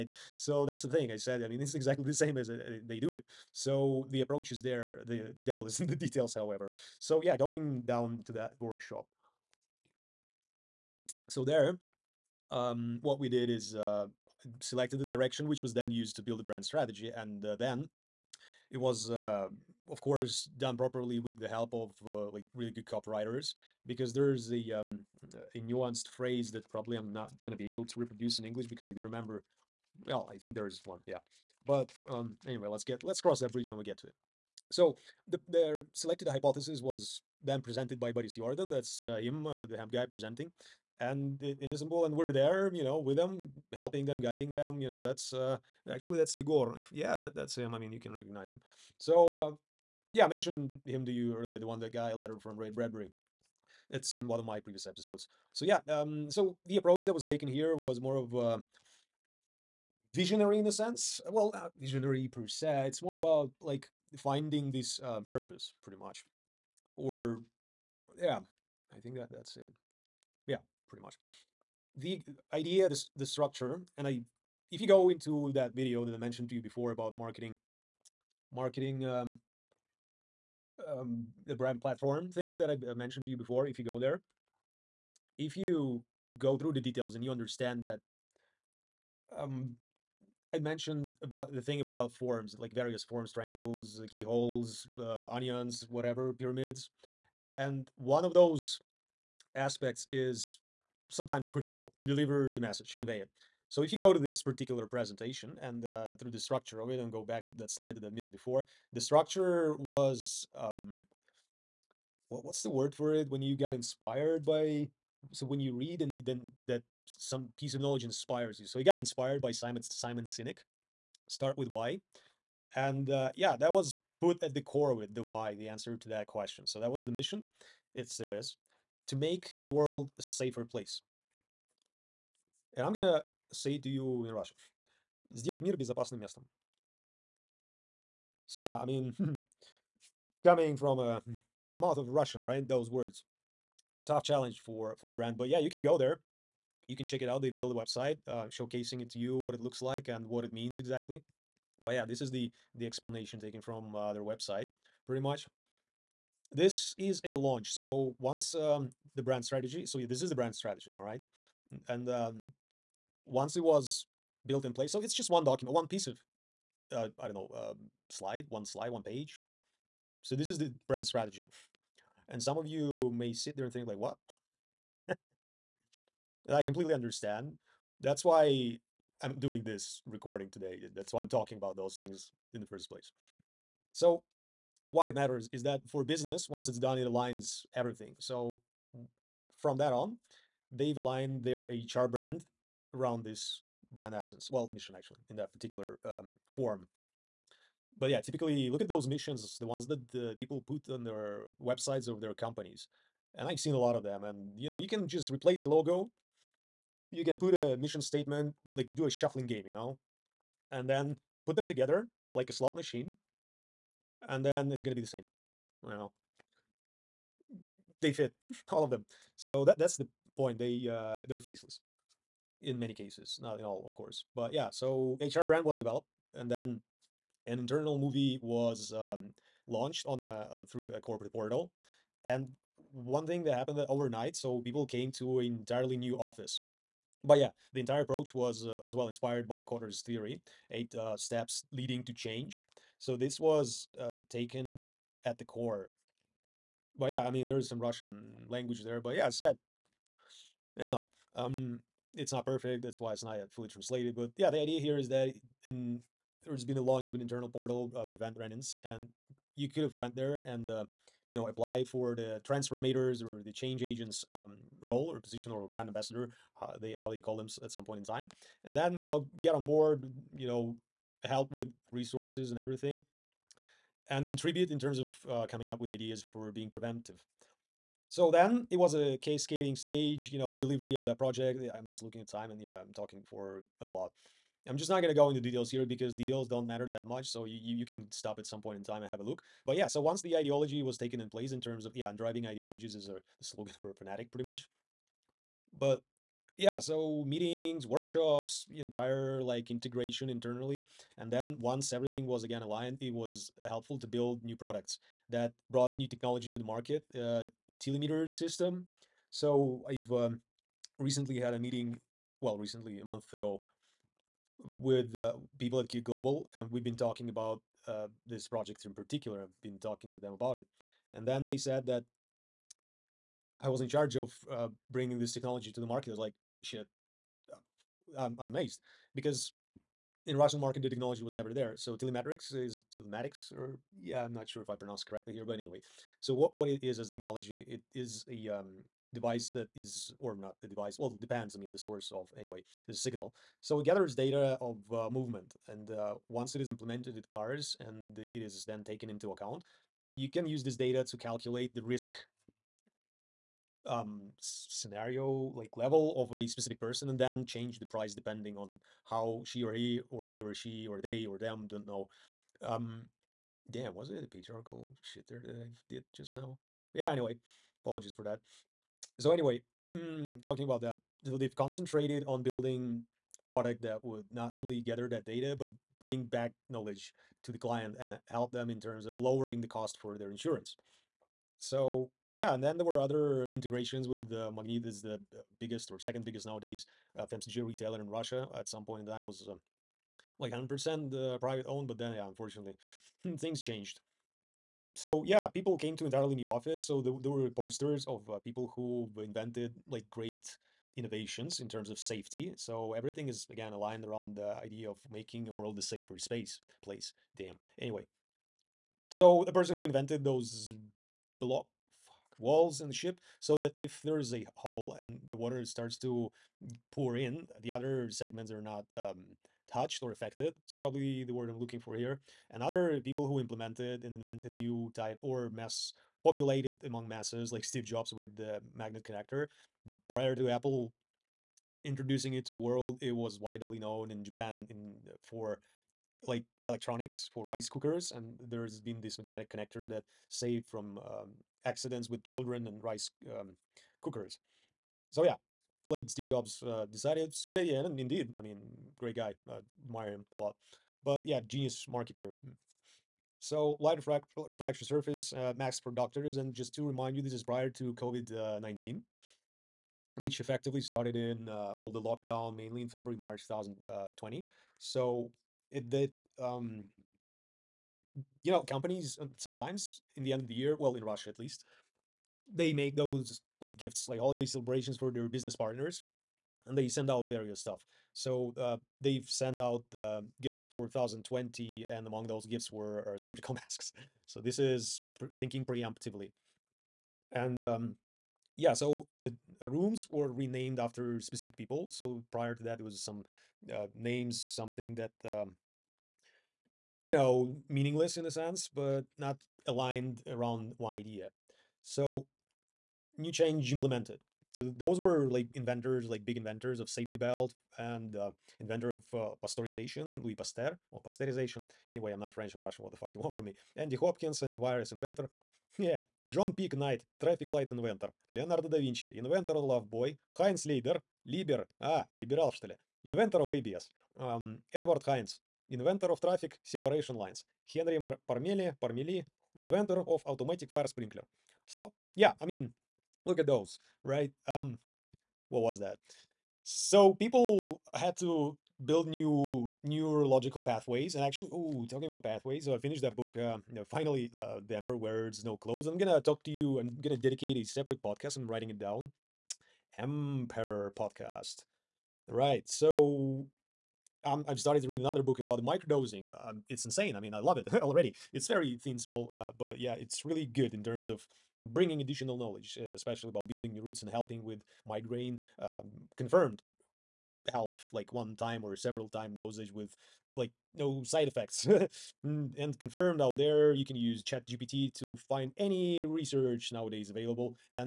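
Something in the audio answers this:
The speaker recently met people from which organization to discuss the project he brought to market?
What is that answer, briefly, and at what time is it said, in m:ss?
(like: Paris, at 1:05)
Key Global, at 5:15.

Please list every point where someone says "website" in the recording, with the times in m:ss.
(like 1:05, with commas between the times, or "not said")
2:27, 2:34, 3:21.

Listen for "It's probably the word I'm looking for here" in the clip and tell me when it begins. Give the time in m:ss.
7:00.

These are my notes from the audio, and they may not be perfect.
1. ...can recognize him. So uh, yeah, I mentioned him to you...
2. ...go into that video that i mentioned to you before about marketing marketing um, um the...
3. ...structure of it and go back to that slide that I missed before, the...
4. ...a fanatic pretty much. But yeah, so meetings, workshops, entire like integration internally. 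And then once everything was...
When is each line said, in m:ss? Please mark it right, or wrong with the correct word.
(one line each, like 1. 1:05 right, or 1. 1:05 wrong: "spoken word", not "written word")
1. 0:47 right
2. 1:14 right
3. 1:46 right
4. 4:53 right.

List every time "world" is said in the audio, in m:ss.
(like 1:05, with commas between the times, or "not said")
2:09, 6:45, 7:12.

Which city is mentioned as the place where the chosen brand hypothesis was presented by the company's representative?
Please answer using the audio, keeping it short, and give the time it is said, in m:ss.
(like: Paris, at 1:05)
Istanbul, at 0:41.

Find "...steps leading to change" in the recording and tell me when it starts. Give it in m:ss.
4:01.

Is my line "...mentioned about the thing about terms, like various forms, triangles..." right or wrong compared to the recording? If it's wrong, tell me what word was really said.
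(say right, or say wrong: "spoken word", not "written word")
wrong: "forms", not "terms".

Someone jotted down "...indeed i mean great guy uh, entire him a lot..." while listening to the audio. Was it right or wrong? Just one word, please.
wrong.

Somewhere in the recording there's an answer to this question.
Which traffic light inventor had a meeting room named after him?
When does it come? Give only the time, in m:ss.
8:36.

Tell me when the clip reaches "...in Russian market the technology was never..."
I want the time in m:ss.
5:30.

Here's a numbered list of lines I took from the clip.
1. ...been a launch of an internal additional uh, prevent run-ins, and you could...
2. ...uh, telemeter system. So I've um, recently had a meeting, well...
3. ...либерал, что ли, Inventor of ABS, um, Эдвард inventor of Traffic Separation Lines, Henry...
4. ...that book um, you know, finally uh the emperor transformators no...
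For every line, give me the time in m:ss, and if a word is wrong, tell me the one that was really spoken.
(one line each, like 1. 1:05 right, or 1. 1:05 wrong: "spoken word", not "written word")
1. 4:16 wrong: "portal", not "additional"
2. 5:07 right
3. 8:42 right
4. 9:03 wrong: "wears", not "transformators".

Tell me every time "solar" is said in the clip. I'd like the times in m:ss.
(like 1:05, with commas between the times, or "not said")
not said.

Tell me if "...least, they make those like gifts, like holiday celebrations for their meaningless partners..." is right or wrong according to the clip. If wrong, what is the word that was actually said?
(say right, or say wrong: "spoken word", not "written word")
wrong: "business", not "meaningless".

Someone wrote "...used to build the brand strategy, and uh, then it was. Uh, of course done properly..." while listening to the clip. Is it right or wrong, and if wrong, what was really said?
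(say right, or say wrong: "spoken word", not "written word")
right.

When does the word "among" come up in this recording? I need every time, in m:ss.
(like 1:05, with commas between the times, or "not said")
7:06, 8:02.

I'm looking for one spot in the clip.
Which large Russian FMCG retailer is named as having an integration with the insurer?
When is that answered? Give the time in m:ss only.
6:24.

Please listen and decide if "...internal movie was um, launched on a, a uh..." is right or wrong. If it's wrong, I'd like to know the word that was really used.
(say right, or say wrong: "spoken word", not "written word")
right.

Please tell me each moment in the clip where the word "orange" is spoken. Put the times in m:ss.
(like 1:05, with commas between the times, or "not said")
not said.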